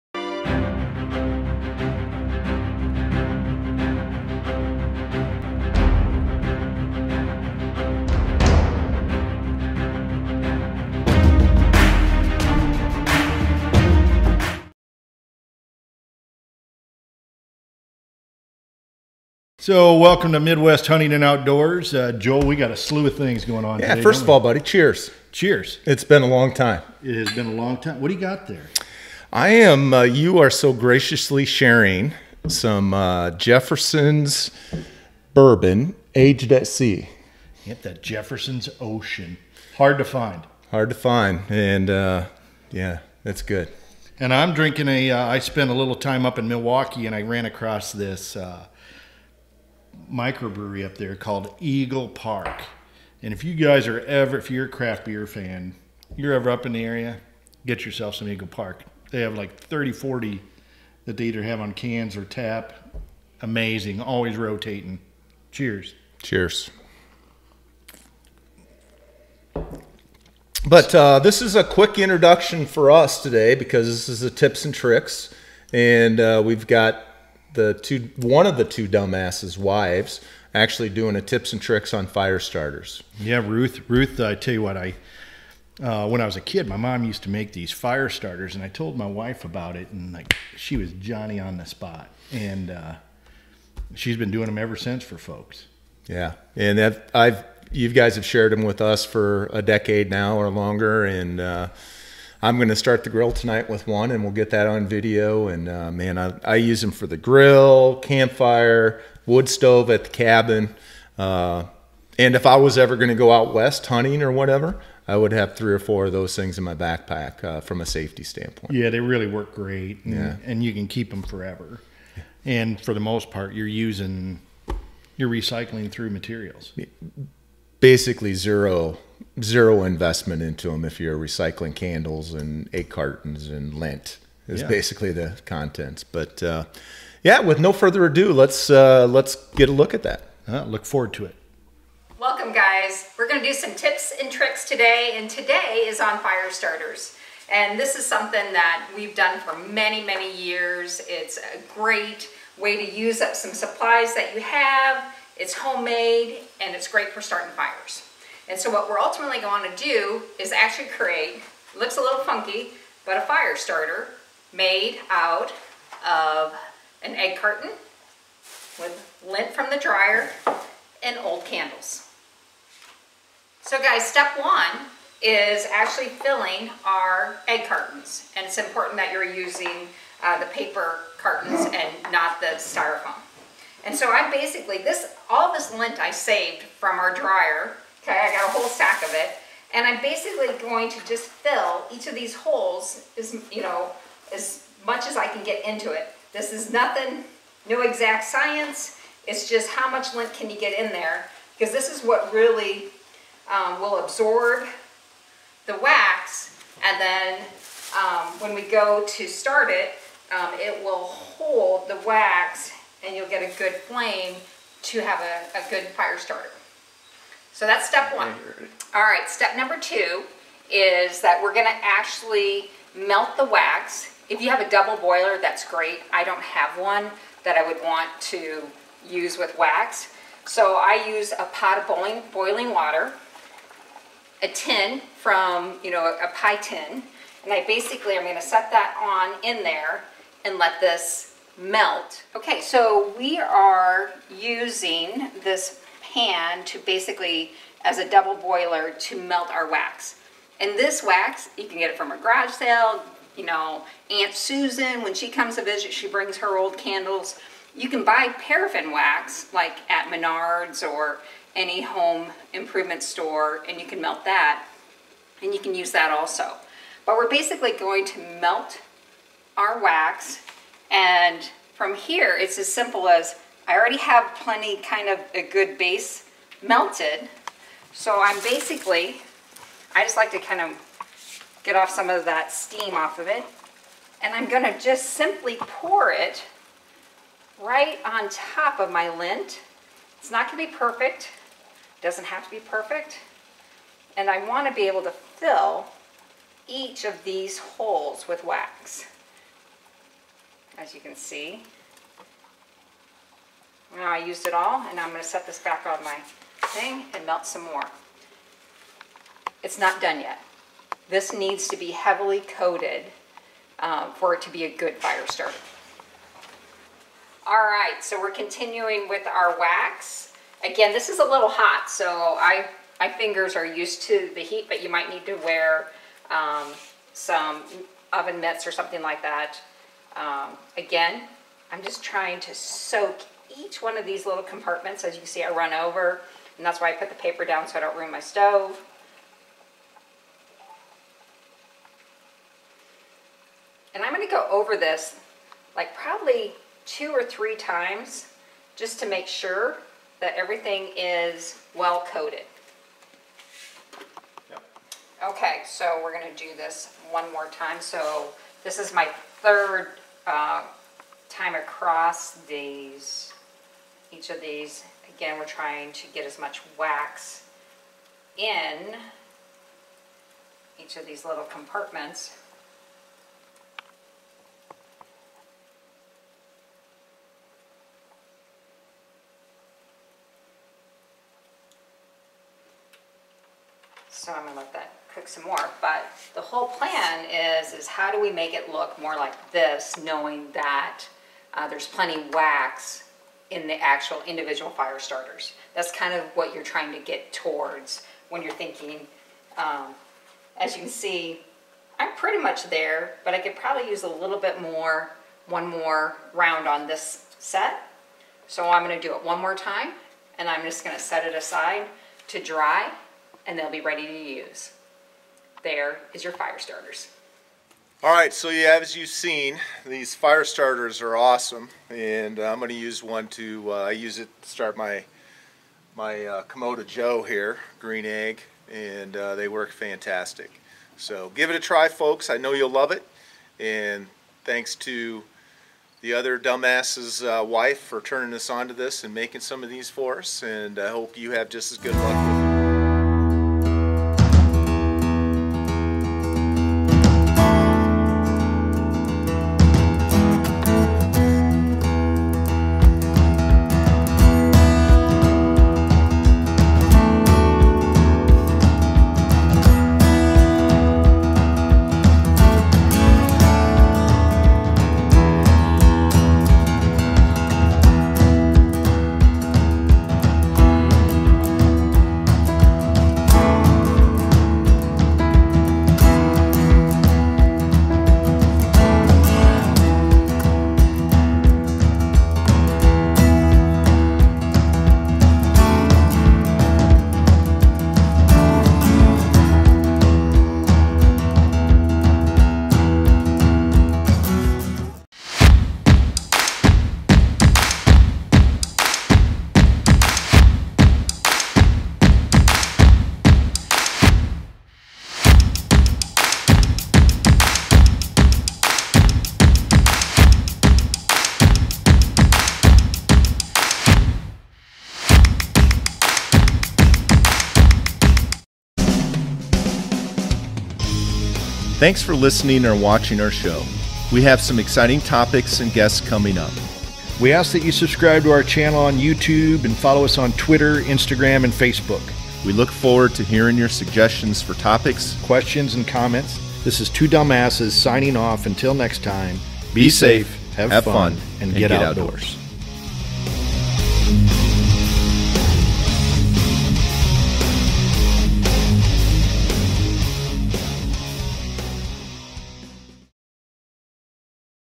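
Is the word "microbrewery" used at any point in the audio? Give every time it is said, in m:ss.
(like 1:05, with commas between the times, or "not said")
0:50.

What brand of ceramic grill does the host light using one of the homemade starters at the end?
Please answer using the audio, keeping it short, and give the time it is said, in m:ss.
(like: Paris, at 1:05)
Kamado Joe, at 7:06.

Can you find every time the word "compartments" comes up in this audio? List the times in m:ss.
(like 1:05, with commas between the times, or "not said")
5:34, 6:11.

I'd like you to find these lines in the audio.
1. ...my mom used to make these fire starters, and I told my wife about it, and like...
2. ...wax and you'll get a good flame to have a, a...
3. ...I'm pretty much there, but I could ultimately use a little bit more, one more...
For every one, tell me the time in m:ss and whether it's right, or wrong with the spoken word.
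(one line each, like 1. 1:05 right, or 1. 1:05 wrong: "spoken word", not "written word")
1. 1:26 right
2. 3:32 right
3. 6:41 wrong: "probably", not "ultimately".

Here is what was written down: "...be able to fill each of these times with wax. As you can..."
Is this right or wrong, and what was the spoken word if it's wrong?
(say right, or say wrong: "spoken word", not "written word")
wrong: "holes", not "times".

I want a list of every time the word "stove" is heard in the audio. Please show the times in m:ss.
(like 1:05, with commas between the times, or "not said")
1:49, 5:38.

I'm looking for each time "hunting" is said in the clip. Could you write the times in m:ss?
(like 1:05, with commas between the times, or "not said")
0:20, 1:53.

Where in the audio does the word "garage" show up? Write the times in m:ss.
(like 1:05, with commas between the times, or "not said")
4:12.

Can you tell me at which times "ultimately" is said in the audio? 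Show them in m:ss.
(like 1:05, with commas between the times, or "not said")
2:38.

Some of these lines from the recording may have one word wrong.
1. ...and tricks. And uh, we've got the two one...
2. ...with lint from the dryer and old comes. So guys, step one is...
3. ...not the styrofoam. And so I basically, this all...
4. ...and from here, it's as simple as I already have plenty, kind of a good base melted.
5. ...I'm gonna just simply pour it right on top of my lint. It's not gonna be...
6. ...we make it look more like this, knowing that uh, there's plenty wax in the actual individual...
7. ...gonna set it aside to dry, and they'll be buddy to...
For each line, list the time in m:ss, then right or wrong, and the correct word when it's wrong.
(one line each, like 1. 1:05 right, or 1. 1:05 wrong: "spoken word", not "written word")
1. 1:14 right
2. 2:48 wrong: "candles", not "comes"
3. 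3:02 right
4. 4:30 right
5. 4:44 right
6. 6:28 right
7. 6:50 wrong: "ready", not "buddy".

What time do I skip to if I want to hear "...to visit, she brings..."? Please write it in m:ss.
4:15.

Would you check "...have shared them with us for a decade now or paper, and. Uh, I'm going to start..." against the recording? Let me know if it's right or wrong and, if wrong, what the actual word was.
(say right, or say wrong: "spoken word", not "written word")
wrong: "longer", not "paper".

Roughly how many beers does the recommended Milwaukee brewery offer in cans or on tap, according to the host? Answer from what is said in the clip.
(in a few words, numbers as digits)
30, 40.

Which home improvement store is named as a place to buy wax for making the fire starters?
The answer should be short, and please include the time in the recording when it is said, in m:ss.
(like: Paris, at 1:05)
Menards, at 4:20.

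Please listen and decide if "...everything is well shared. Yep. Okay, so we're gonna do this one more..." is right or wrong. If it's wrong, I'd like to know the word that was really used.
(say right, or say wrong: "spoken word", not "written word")
wrong: "coated", not "shared".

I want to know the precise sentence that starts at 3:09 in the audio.
And I'm basically going to just fill each of these holes as, you know, as much as I can get into it.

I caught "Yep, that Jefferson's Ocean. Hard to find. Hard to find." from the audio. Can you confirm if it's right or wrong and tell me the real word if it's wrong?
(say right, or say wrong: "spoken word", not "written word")
right.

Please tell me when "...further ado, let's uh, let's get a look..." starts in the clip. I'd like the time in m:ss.
2:17.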